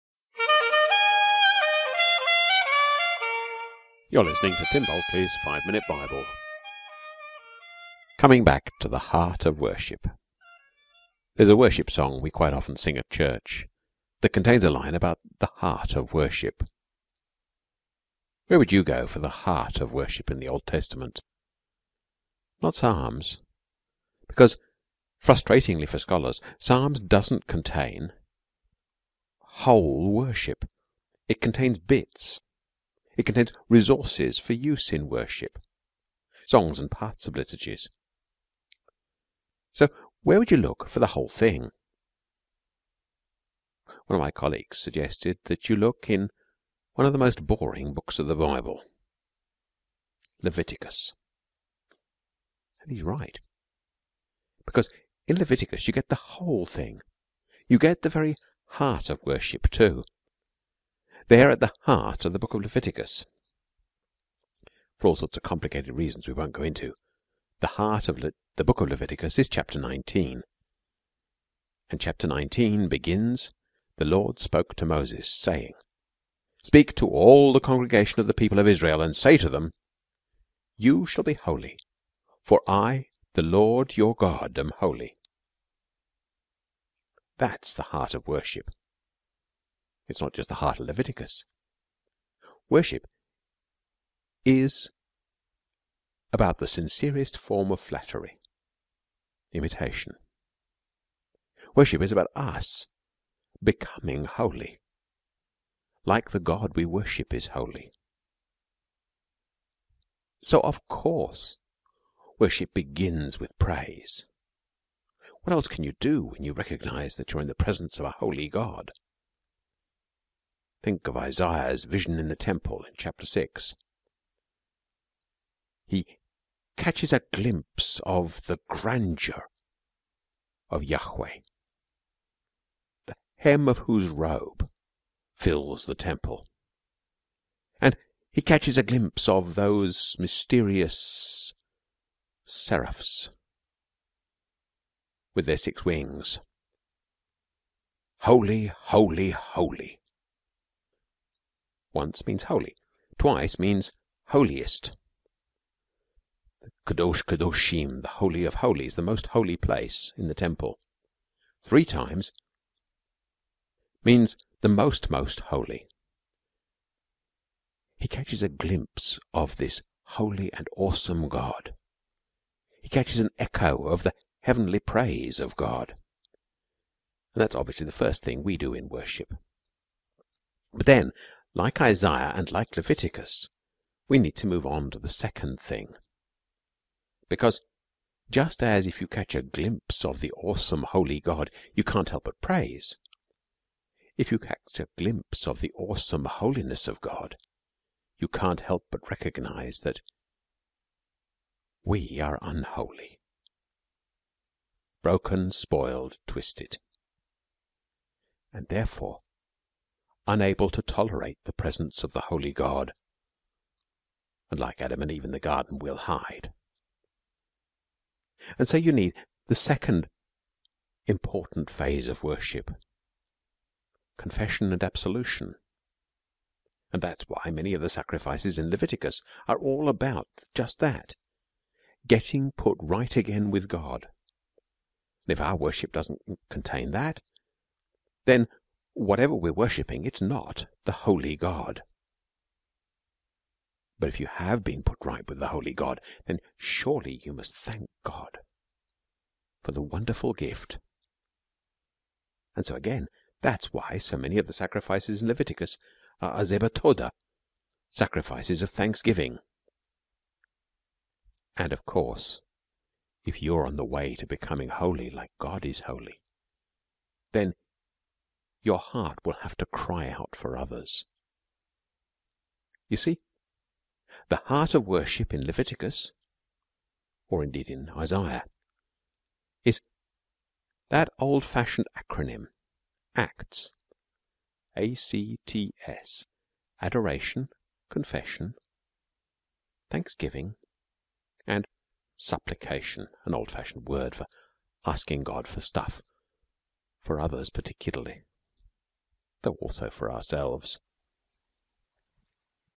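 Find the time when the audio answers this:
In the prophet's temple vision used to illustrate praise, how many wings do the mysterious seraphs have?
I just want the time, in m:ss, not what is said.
2:25.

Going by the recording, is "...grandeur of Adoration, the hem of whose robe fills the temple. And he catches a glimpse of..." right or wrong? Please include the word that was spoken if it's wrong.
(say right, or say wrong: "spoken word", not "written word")
wrong: "Yahweh", not "Adoration".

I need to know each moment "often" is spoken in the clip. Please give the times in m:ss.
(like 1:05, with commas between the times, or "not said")
0:12.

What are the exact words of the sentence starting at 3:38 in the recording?
And so you need the second important phase of worship confession and absolution.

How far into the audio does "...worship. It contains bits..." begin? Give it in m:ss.
0:30.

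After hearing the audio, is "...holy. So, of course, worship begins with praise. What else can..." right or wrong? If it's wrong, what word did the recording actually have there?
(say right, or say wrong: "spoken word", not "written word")
right.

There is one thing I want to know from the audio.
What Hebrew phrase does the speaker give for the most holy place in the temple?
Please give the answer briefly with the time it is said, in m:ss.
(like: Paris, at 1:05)
Kadosh Kadoshim, at 2:36.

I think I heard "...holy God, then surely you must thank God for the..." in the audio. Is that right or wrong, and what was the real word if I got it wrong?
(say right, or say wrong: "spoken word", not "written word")
right.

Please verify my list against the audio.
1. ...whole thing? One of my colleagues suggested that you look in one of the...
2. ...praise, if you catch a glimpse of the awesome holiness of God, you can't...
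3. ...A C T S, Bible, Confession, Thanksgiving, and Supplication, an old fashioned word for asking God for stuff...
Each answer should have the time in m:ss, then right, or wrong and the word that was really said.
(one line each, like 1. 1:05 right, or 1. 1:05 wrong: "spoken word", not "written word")
1. 0:41 right
2. 3:12 right
3. 4:44 wrong: "Adoration", not "Bible".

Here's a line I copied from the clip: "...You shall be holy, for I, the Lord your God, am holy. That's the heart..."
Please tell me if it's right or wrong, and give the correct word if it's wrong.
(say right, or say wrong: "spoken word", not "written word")
right.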